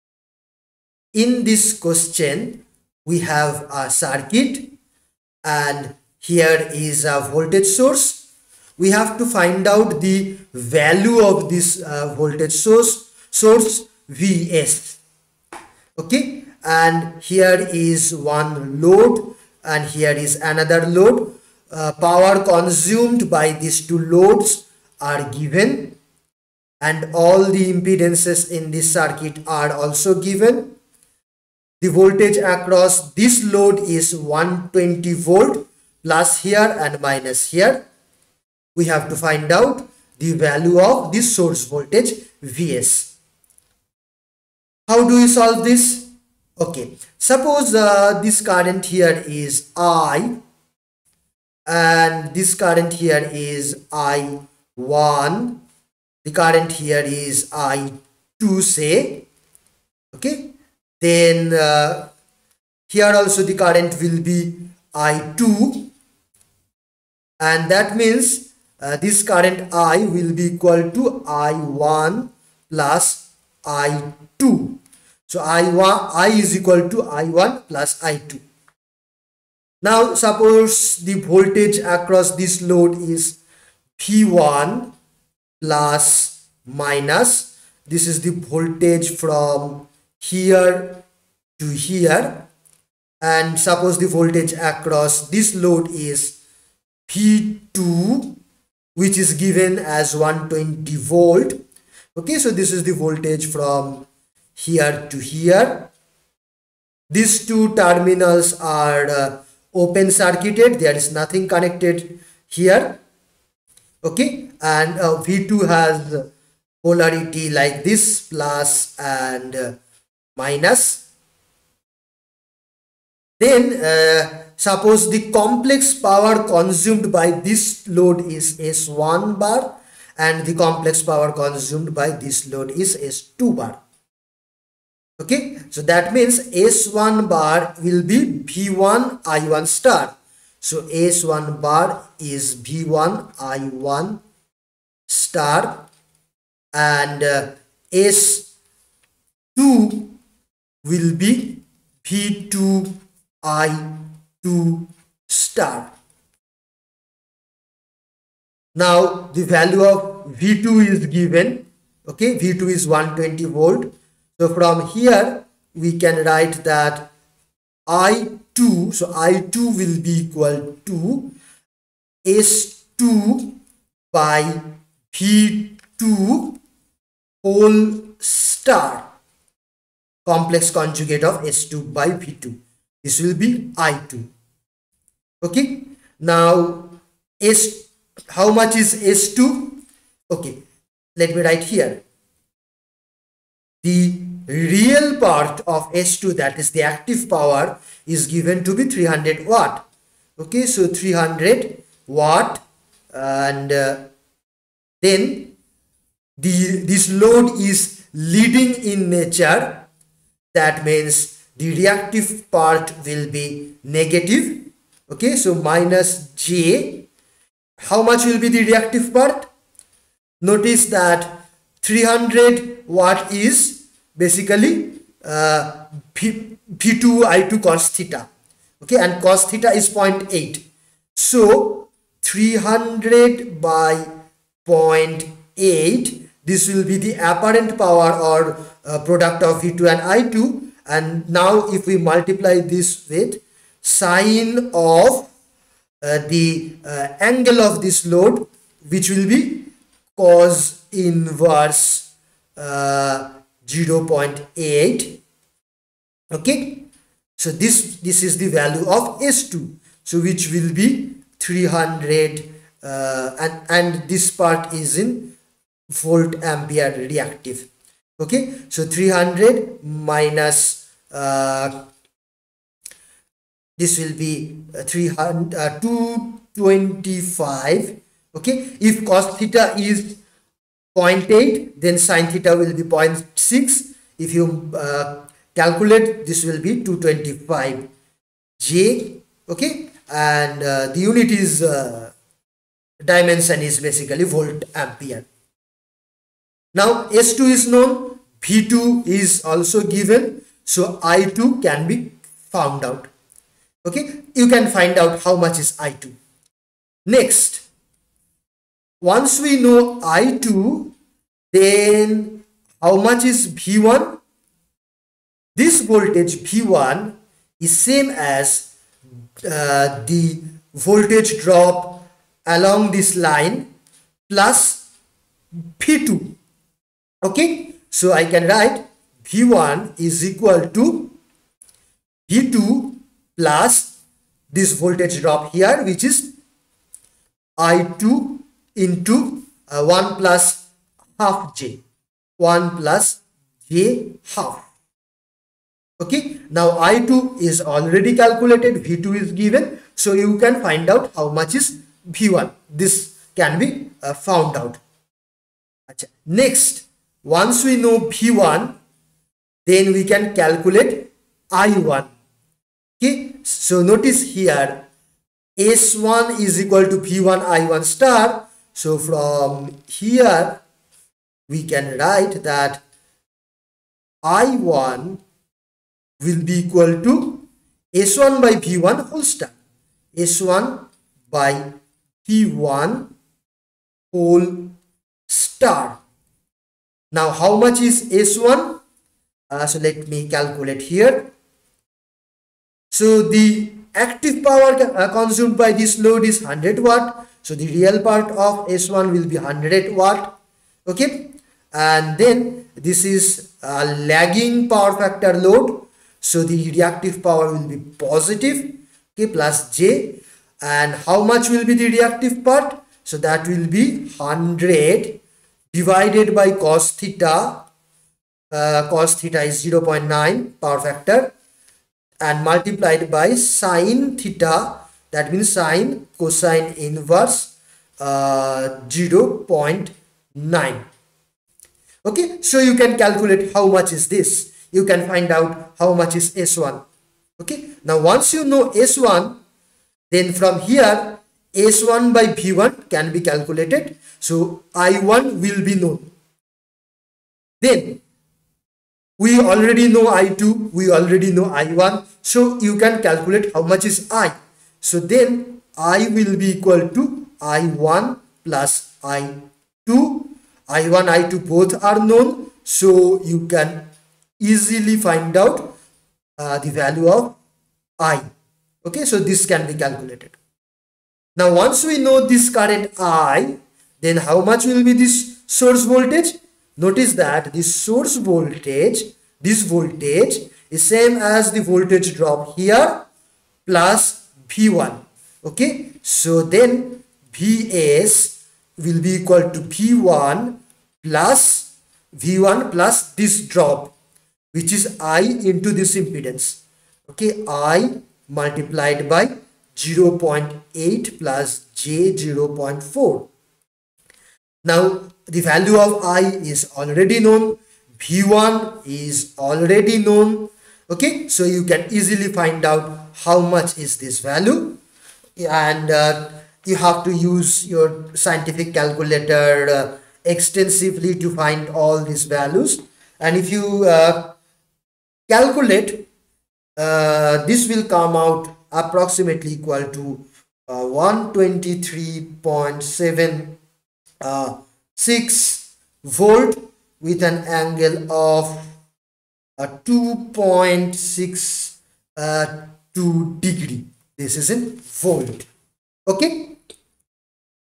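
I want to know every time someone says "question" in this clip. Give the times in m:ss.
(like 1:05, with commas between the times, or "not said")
0:01.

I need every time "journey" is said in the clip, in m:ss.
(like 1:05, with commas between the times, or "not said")
not said.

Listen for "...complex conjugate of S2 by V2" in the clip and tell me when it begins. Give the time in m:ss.
3:00.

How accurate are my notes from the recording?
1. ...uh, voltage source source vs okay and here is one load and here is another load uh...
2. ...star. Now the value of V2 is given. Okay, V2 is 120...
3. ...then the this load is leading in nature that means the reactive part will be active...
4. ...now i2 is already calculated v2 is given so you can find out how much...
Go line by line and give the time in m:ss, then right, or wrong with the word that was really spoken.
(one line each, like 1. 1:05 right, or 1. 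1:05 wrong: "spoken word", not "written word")
1. 0:11 right
2. 2:35 right
3. 3:25 wrong: "negative", not "active"
4. 5:46 right.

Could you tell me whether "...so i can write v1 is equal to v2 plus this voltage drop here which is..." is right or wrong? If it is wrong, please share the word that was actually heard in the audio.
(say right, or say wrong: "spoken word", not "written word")
right.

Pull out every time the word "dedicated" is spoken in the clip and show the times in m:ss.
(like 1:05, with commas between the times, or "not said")
not said.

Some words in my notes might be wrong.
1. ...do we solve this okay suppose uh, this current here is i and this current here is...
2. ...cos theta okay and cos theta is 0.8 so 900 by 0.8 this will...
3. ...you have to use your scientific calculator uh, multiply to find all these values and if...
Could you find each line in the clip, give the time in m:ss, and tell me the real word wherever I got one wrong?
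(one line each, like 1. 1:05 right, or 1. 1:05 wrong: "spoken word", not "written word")
1. 0:45 right
2. 3:47 wrong: "300", not "900"
3. 8:36 wrong: "extensively", not "multiply".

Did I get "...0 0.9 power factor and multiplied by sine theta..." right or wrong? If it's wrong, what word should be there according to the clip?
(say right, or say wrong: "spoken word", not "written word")
right.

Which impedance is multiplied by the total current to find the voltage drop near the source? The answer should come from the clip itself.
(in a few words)
0.8 + j0.4.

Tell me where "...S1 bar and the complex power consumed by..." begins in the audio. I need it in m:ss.
2:08.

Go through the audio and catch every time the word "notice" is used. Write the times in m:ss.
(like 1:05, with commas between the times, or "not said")
3:40, 6:03, 7:56.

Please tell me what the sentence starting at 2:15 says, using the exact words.
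Okay, so that means S1 bar will be V1 I1 star.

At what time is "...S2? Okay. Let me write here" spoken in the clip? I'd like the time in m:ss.
3:09.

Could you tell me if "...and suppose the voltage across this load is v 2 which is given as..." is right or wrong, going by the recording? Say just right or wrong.
right.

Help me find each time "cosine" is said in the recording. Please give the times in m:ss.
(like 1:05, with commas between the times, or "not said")
7:06.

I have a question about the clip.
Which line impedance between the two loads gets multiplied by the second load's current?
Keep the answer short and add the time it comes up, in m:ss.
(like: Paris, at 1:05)
1 + j0.5, at 5:42.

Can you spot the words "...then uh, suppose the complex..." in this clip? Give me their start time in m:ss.
2:03.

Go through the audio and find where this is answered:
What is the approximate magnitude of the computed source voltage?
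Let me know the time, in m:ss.
8:50.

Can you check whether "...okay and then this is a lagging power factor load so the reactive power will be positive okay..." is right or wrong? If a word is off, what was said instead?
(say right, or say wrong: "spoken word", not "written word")
right.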